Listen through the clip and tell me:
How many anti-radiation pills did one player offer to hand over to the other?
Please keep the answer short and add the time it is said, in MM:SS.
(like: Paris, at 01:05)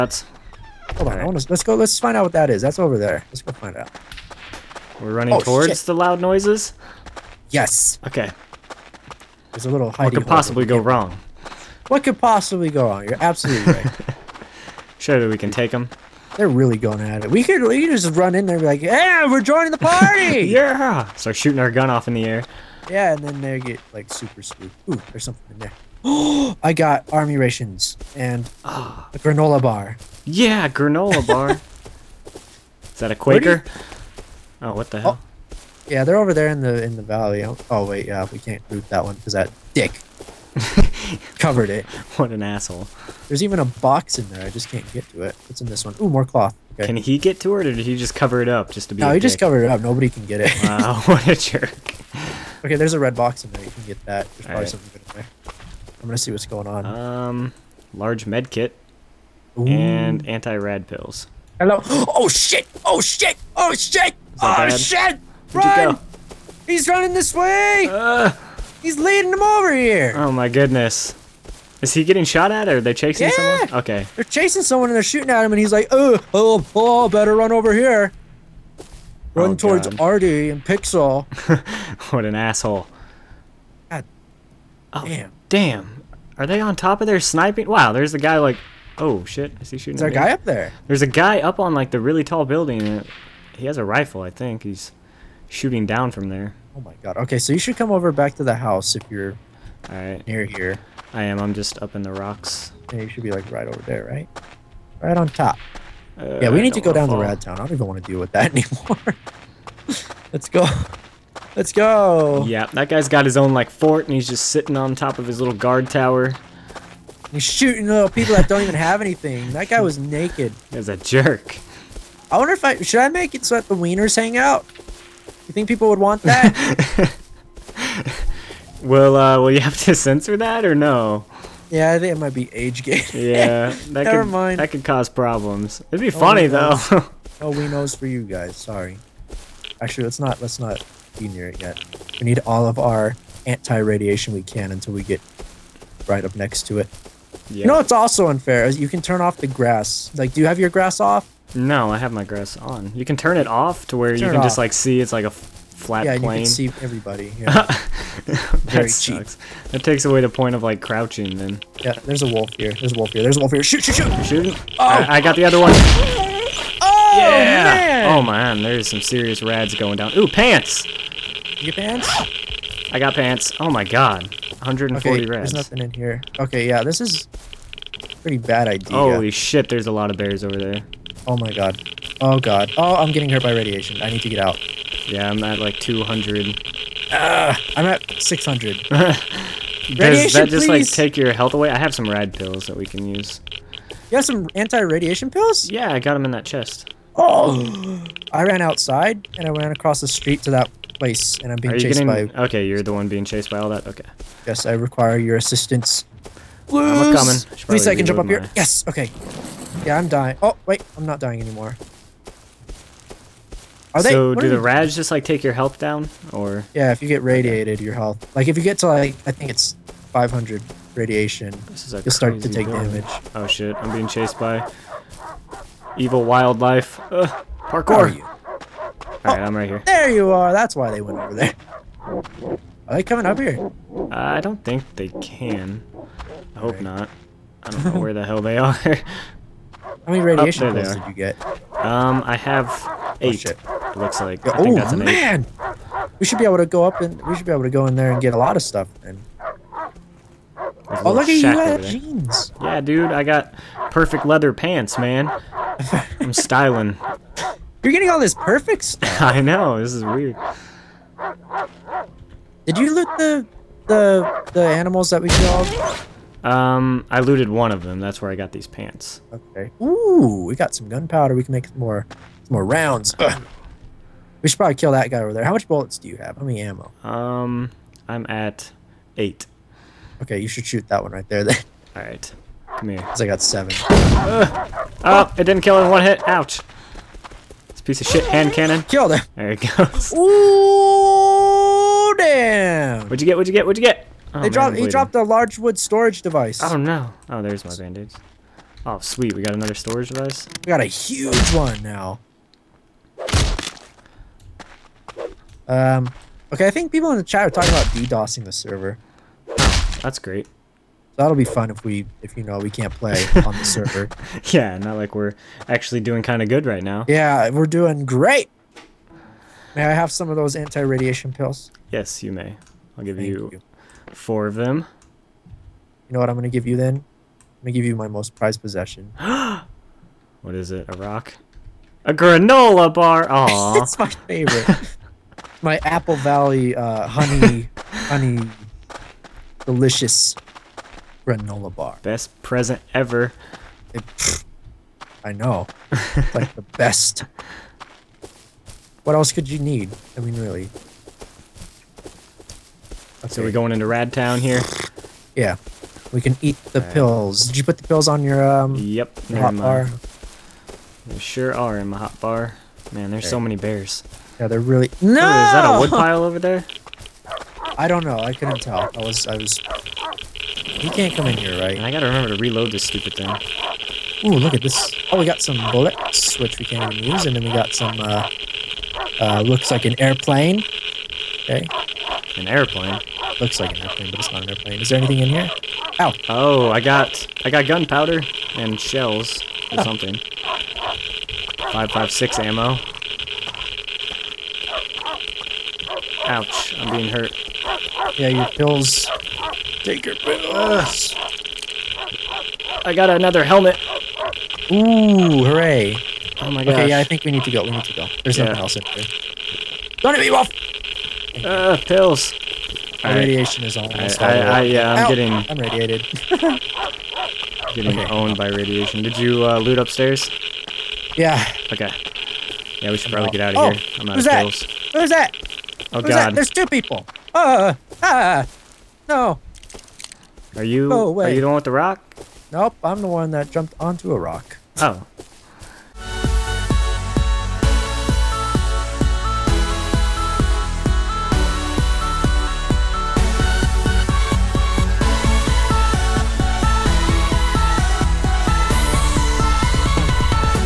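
4, at 05:24.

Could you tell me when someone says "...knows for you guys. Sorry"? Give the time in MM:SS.
02:17.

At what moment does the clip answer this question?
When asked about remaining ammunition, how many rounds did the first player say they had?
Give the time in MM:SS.
04:38.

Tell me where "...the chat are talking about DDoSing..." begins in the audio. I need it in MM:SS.
05:07.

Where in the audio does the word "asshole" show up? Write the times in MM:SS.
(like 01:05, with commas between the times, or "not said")
00:42, 01:22.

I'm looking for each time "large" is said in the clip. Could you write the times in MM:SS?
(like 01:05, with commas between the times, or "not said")
00:57, 04:55.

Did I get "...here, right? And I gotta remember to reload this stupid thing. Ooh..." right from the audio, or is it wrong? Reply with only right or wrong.
right.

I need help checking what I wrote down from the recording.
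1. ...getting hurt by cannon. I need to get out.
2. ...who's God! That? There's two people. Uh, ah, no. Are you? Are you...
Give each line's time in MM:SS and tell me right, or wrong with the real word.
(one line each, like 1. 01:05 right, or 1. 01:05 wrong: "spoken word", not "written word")
1. 03:03 wrong: "radiation", not "cannon"
2. 07:06 right.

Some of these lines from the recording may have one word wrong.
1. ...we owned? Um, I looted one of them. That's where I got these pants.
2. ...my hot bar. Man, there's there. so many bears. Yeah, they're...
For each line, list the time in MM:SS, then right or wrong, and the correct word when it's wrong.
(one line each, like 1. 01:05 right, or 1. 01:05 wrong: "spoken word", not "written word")
1. 04:25 wrong: "killed", not "owned"
2. 06:01 right.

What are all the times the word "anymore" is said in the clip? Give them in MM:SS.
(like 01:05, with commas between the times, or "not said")
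01:48, 03:31.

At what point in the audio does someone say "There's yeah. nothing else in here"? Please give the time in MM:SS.
06:48.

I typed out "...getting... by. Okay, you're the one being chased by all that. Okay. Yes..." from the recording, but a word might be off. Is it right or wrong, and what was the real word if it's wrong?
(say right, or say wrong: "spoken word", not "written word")
right.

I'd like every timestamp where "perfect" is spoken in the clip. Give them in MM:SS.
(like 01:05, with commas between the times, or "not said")
04:13, 04:18.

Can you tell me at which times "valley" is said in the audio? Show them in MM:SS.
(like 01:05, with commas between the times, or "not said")
00:37, 05:36.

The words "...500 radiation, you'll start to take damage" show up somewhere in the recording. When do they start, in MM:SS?
03:40.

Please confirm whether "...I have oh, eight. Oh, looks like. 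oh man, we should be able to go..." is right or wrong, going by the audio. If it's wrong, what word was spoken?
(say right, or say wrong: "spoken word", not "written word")
right.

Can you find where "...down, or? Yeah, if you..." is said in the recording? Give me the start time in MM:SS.
03:35.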